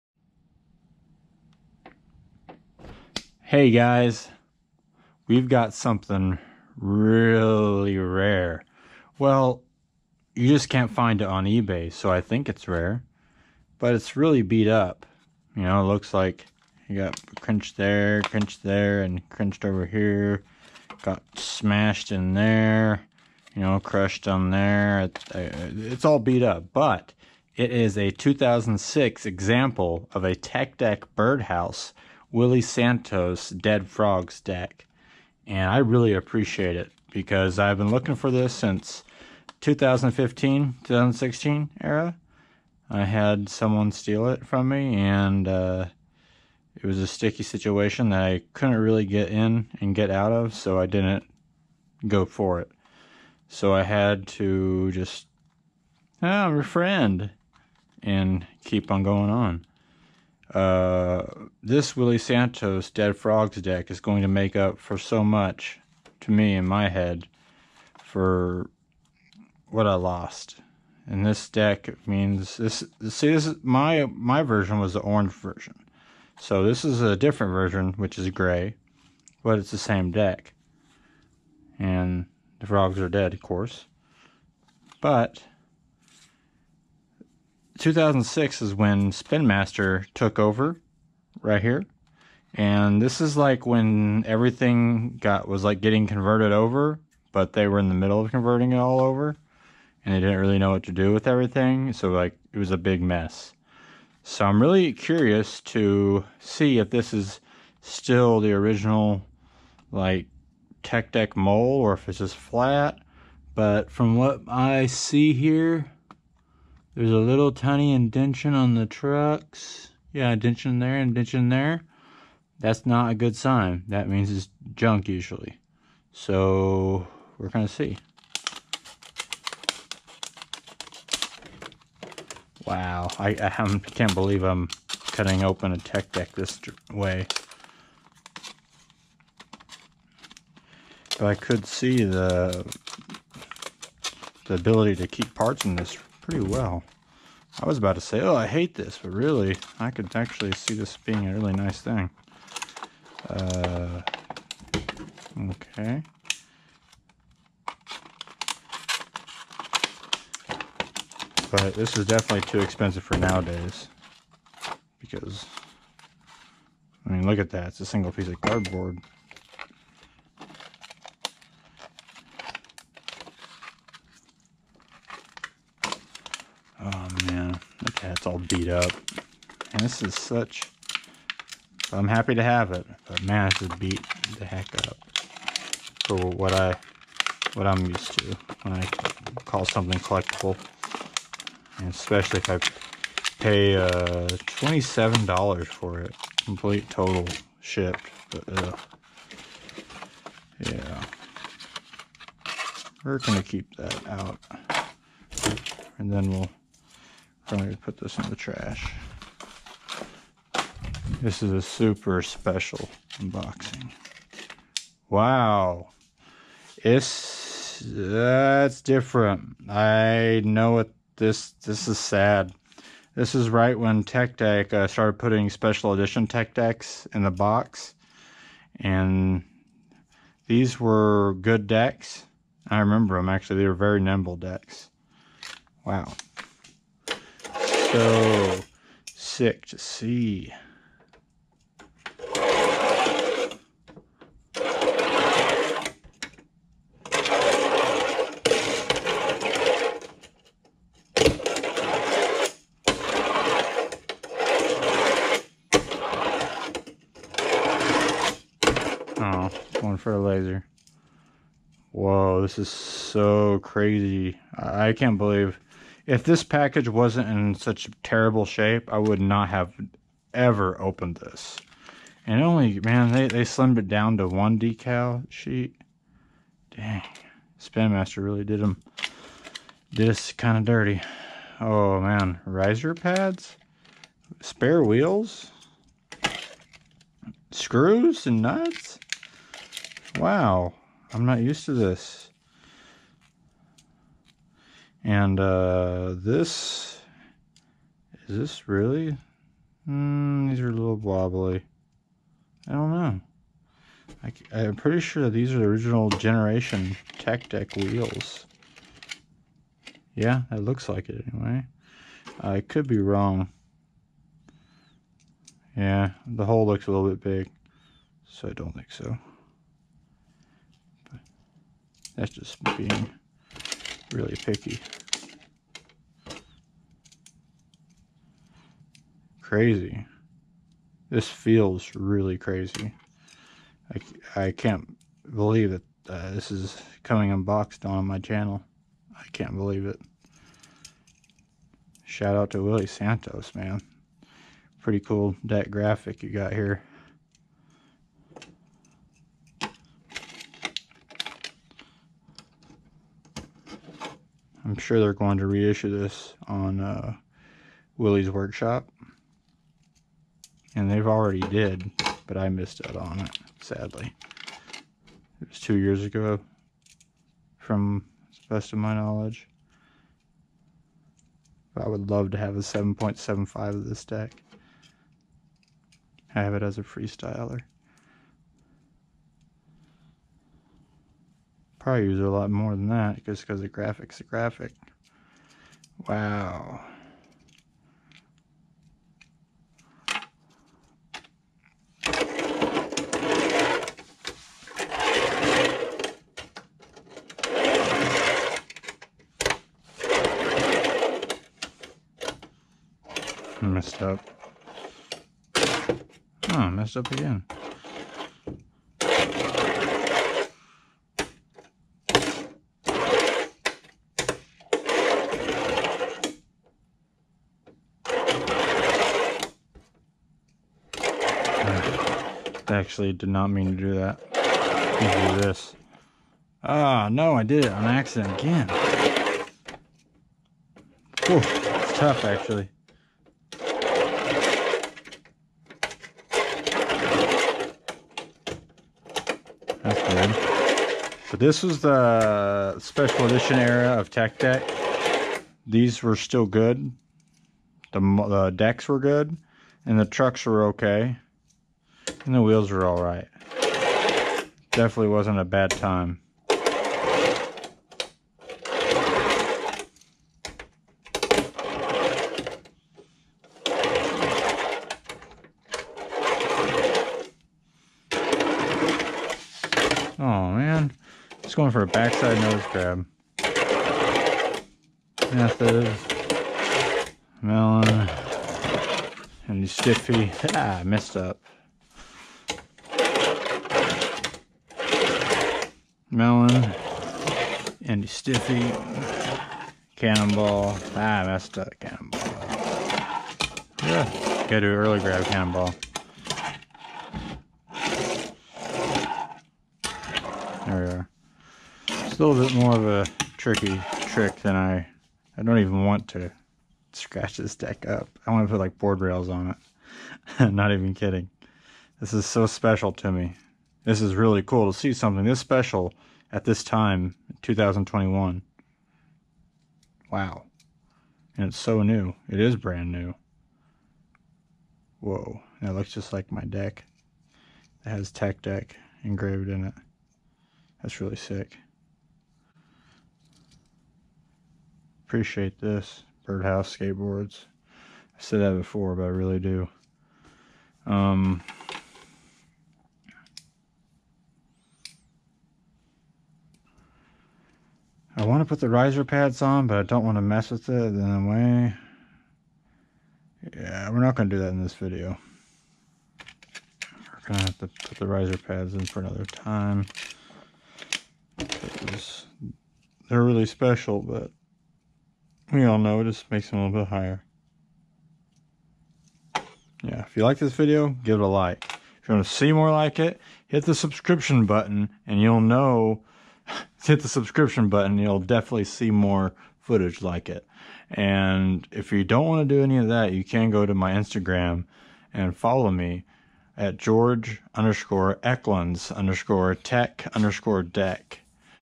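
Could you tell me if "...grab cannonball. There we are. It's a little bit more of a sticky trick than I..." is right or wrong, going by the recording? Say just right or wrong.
wrong.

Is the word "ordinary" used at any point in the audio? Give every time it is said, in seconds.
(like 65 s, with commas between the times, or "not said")
not said.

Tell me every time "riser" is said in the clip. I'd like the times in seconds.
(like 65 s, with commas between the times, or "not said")
282 s, 548 s, 558 s.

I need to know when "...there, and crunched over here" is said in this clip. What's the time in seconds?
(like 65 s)
18 s.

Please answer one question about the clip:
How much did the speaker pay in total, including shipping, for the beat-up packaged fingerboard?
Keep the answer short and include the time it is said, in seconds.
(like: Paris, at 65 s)
$27, at 194 s.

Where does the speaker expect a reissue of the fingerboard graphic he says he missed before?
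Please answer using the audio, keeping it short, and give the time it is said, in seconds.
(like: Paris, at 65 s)
Willy's Workshop, at 357 s.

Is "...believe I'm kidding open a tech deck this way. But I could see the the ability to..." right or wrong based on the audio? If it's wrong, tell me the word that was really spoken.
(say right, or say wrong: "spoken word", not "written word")
wrong: "cutting", not "kidding".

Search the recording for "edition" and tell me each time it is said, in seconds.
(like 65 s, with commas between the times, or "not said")
225 s, 443 s.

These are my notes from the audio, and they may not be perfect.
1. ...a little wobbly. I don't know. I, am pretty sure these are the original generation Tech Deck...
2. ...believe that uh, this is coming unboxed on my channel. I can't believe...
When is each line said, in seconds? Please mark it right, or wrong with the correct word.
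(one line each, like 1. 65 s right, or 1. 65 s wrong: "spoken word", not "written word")
1. 300 s right
2. 335 s right.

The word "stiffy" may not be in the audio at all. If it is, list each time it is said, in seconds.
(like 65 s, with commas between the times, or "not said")
479 s, 488 s.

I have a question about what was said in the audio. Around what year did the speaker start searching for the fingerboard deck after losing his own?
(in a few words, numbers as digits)
2015.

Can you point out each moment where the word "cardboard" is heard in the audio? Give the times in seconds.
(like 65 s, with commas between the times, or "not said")
168 s.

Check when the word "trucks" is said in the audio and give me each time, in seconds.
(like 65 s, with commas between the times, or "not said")
118 s, 450 s.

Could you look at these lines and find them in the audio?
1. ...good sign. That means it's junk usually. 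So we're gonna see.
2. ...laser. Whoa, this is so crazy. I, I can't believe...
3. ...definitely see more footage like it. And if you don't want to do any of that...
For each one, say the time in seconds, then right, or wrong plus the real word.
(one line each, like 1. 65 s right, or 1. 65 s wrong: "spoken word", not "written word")
1. 123 s right
2. 260 s right
3. 578 s right.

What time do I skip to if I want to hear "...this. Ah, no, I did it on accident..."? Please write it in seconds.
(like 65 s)
425 s.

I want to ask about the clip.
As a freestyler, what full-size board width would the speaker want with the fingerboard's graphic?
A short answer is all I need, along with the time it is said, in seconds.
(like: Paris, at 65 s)
7.75, at 372 s.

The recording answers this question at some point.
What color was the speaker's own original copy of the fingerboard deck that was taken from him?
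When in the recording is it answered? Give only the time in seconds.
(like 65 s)
74 s.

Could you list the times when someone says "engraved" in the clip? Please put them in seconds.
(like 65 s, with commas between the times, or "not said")
529 s.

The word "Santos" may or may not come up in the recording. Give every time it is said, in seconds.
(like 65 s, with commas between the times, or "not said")
32 s, 62 s, 342 s.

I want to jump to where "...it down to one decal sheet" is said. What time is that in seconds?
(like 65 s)
273 s.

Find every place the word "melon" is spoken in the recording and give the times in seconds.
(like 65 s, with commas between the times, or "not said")
477 s, 486 s.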